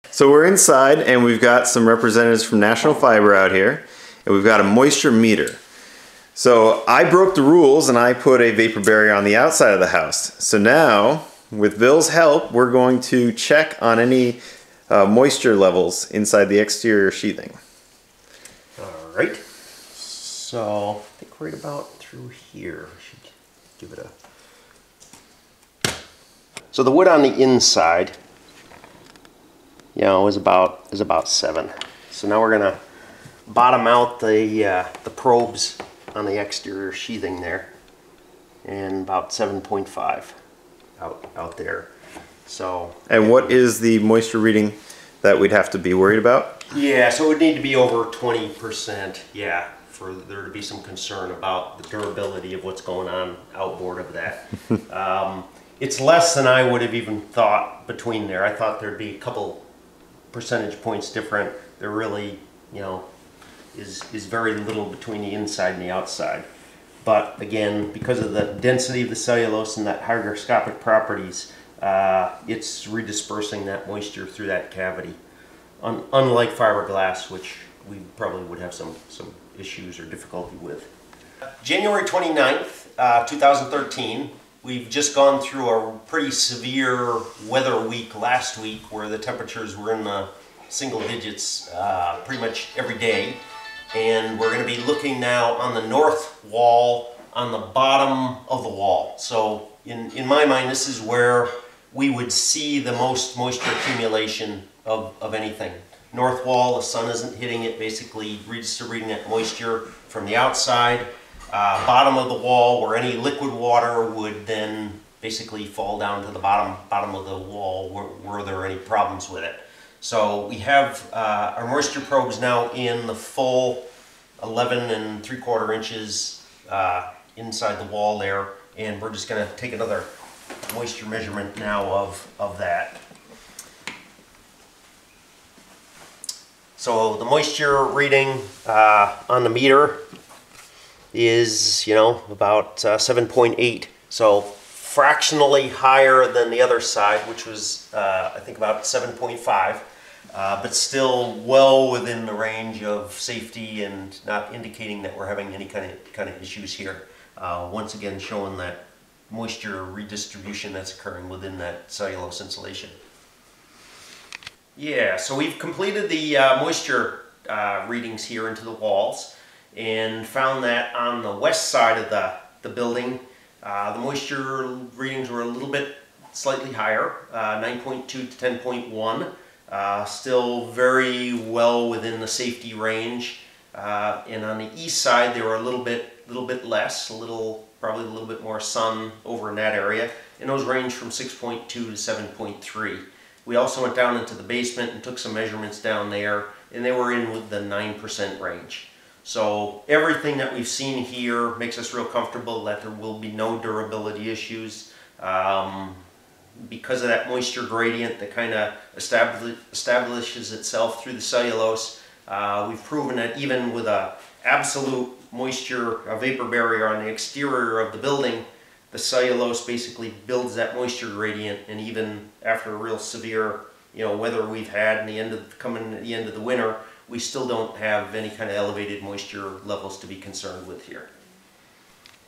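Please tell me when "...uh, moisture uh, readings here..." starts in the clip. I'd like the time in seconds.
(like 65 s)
166 s.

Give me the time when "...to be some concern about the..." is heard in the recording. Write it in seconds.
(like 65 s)
50 s.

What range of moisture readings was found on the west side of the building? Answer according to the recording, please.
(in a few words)
9.2 to 10.1.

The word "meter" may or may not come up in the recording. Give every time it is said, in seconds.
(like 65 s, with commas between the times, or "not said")
5 s, 139 s.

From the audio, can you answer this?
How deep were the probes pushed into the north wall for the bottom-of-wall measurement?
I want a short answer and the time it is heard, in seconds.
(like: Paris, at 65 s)
11 and 3/4 inches, at 124 s.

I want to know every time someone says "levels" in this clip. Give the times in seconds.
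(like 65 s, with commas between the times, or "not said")
15 s, 229 s.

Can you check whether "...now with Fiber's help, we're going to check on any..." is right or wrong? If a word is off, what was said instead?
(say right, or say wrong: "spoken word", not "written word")
wrong: "Bill", not "Fiber".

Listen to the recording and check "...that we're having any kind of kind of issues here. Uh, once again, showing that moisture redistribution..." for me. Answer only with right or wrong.
right.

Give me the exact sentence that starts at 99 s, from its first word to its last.
So in, in my mind, this is where we would see the most moisture accumulation of, of anything.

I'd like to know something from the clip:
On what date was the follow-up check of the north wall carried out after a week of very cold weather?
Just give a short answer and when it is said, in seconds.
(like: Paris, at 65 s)
January 29th, 2013, at 81 s.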